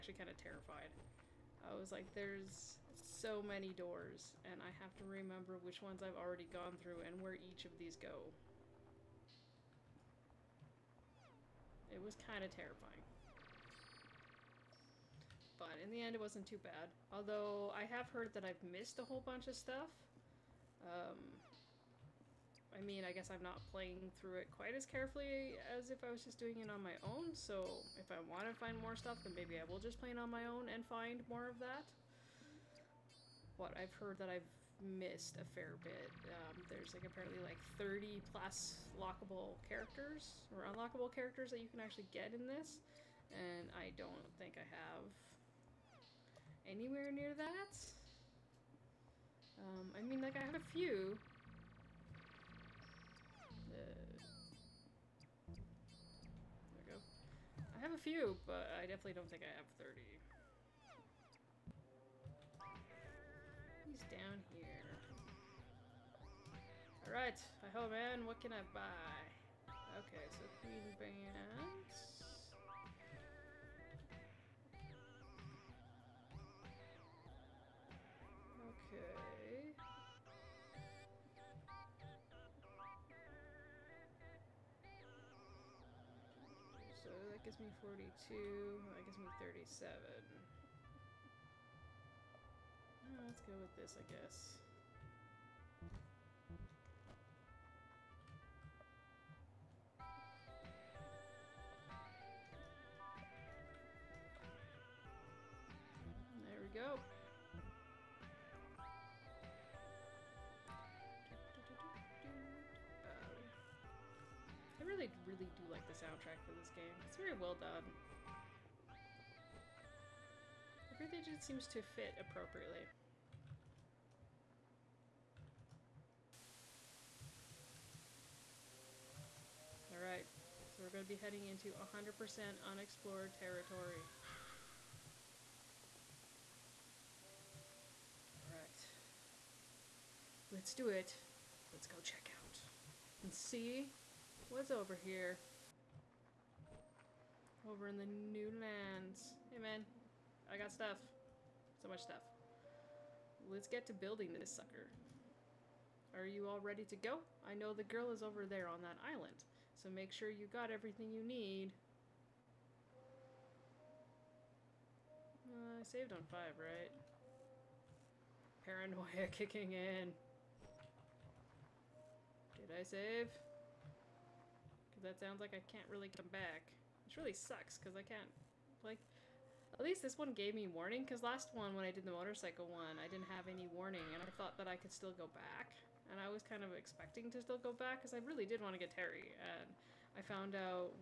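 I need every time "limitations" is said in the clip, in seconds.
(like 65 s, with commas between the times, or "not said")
not said.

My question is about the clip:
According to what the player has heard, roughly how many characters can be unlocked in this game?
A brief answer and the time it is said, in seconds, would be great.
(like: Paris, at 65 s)
30 plus, at 37 s.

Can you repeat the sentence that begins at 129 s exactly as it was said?
Alright, so we're going to be heading into 100% unexplored territory.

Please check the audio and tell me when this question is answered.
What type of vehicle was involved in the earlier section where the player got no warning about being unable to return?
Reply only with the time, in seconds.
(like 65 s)
182 s.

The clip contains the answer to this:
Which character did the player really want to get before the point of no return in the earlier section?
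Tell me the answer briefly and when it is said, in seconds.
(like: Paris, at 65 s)
Terry, at 188 s.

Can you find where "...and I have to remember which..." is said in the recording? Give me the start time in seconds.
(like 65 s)
4 s.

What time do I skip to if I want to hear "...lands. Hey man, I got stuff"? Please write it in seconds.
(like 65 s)
148 s.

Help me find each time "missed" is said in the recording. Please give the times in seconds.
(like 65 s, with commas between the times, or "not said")
18 s, 34 s.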